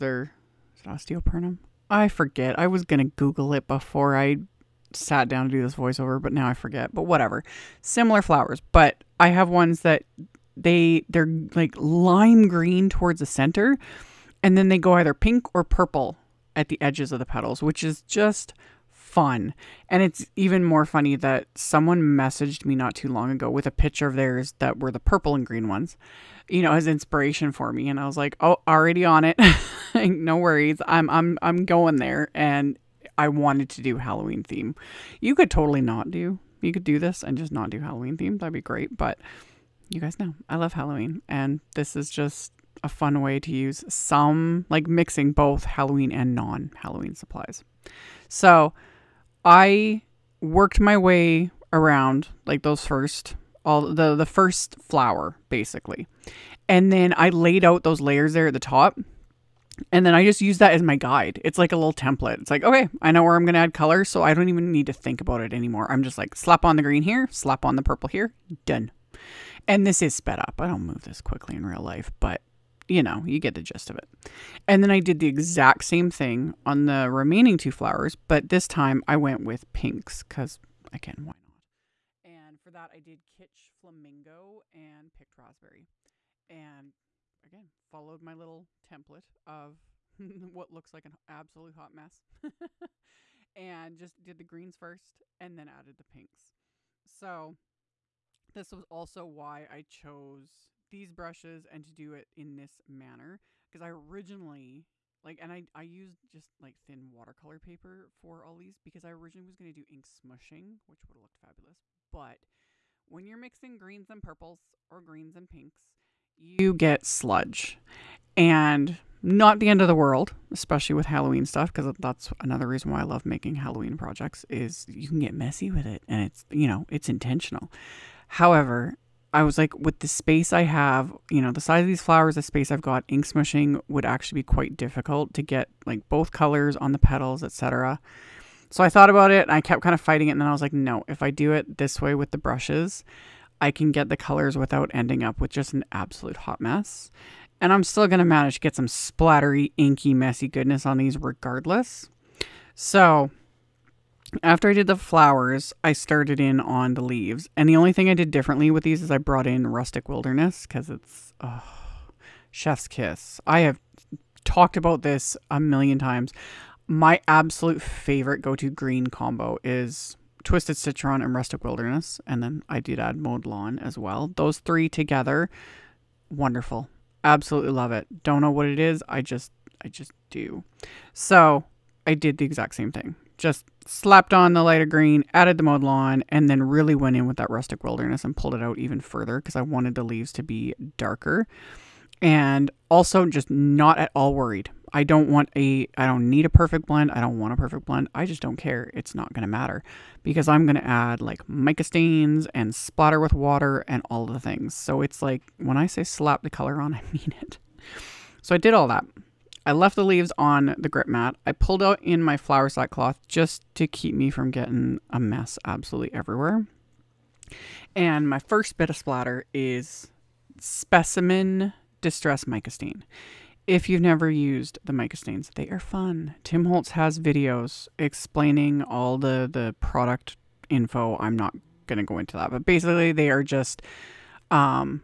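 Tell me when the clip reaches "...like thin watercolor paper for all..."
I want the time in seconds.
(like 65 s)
106 s.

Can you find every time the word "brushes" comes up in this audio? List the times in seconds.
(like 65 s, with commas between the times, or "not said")
101 s, 142 s.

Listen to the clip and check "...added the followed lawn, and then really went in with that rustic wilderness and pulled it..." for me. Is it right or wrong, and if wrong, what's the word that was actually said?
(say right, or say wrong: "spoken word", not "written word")
wrong: "mowed", not "followed".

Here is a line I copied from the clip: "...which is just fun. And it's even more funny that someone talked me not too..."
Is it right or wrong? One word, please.
wrong.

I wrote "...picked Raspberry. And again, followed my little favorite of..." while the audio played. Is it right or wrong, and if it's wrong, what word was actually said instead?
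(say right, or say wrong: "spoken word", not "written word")
wrong: "template", not "favorite".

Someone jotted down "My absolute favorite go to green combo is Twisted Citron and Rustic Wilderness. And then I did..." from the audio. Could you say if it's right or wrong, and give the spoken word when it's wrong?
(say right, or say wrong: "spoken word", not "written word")
right.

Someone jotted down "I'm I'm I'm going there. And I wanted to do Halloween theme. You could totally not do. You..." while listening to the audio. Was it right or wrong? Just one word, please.
right.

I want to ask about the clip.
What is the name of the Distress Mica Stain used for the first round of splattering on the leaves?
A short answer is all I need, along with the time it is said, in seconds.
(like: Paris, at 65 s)
Specimen, at 220 s.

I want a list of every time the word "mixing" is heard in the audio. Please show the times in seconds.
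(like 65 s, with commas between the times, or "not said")
44 s, 113 s.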